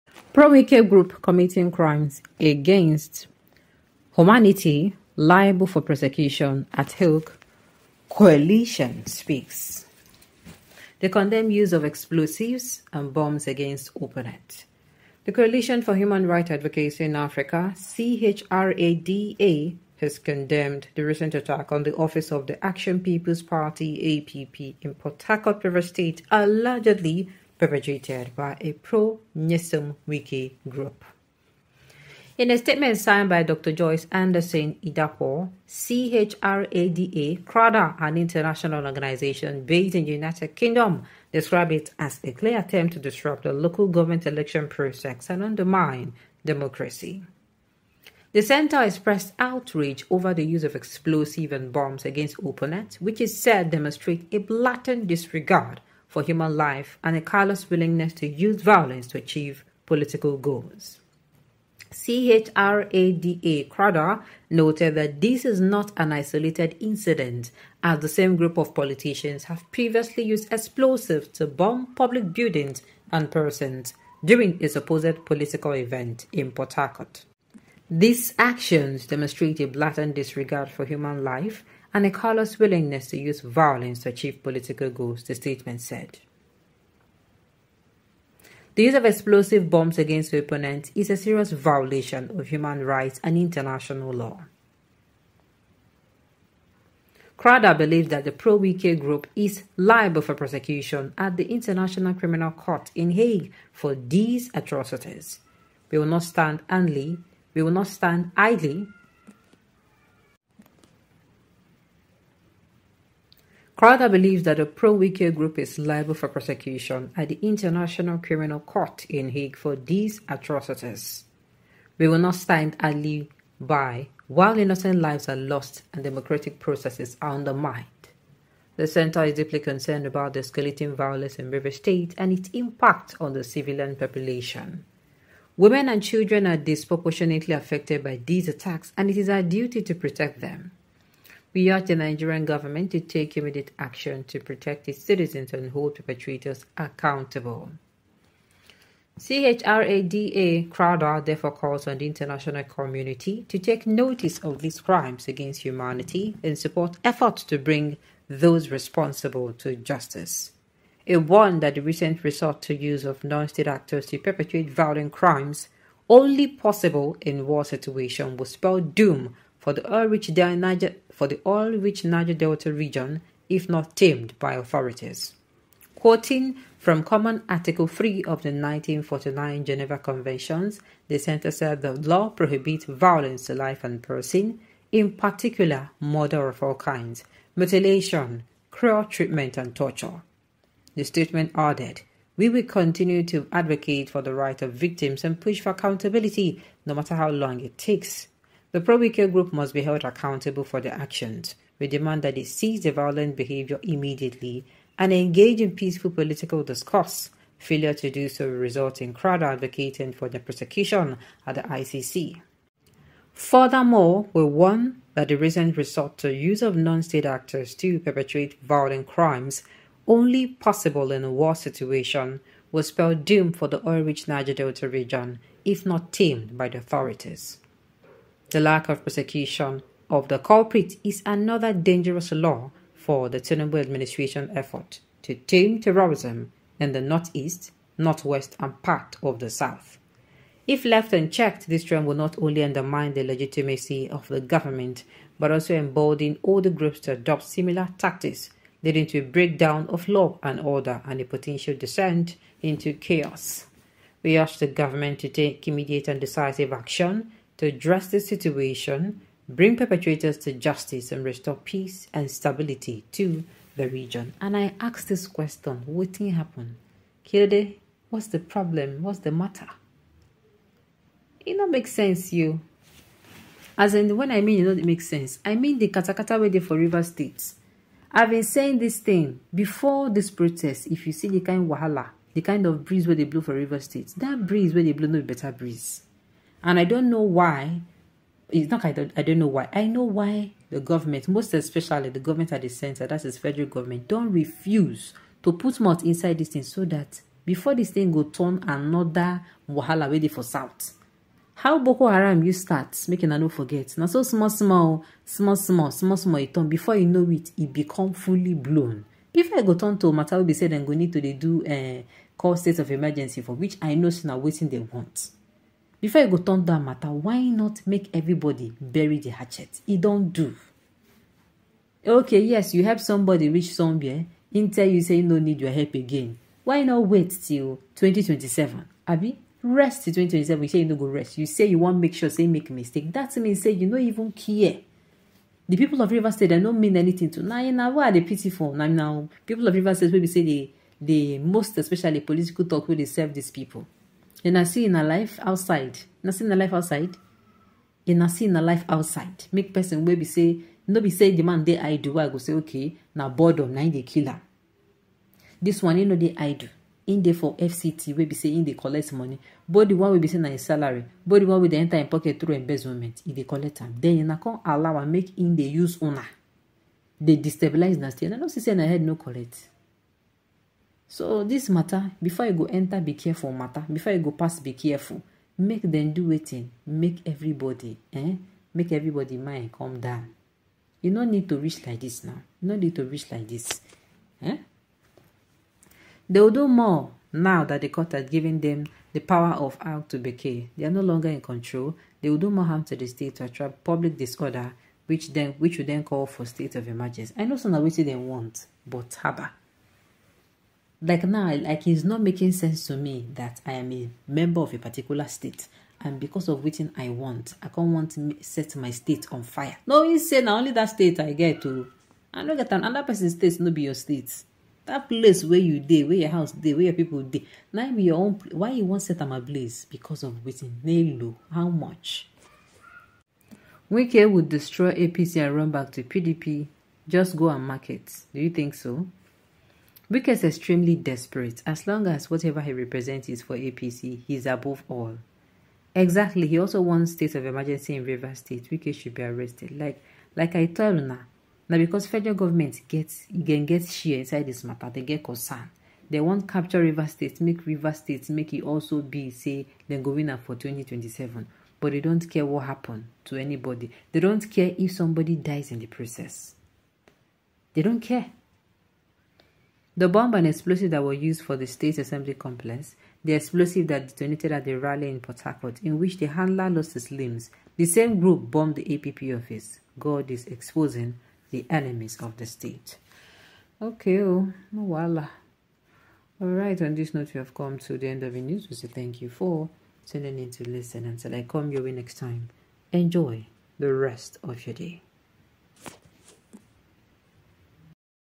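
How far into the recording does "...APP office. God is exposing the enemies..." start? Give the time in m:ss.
7:48.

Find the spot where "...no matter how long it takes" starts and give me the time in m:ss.
3:16.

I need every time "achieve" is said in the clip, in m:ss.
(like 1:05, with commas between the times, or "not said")
0:59, 1:24.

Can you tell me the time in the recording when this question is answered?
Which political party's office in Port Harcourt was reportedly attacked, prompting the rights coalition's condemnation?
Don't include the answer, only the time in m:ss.
0:22.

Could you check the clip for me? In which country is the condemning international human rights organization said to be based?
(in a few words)
United Kingdom.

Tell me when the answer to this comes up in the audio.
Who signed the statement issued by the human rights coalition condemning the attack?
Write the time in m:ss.
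0:33.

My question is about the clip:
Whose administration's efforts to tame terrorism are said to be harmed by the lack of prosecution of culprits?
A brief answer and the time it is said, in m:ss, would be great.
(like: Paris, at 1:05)
Tinubu, at 3:53.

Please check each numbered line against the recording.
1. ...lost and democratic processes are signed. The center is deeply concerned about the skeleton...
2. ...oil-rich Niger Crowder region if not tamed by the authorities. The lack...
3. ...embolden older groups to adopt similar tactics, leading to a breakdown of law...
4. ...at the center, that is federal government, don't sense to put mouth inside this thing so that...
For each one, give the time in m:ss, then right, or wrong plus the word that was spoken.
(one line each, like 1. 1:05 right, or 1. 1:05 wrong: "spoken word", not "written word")
1. 2:05 wrong: "undermined", not "signed"
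2. 3:43 wrong: "Delta", not "Crowder"
3. 4:05 right
4. 4:52 wrong: "refuse", not "sense".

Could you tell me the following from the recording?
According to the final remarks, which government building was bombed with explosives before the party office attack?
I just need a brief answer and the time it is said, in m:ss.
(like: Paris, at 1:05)
State Assembly complex, at 7:41.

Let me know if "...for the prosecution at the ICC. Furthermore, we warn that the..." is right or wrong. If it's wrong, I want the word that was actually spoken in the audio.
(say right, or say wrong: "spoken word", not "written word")
right.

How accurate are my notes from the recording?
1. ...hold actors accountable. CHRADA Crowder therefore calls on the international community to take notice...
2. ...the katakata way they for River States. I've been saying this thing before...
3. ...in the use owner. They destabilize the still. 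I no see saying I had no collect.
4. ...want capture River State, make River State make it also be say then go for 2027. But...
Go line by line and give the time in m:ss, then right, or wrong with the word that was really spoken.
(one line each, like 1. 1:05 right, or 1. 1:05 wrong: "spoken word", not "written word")
1. 2:25 wrong: "perpetrators", not "actors"
2. 4:35 right
3. 6:05 wrong: "correct", not "collect"
4. 7:26 right.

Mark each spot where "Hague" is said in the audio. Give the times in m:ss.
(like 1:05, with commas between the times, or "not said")
0:06, 1:43, 1:59.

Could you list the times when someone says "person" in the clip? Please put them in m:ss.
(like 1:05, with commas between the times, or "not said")
1:13, 3:04, 5:49, 6:53.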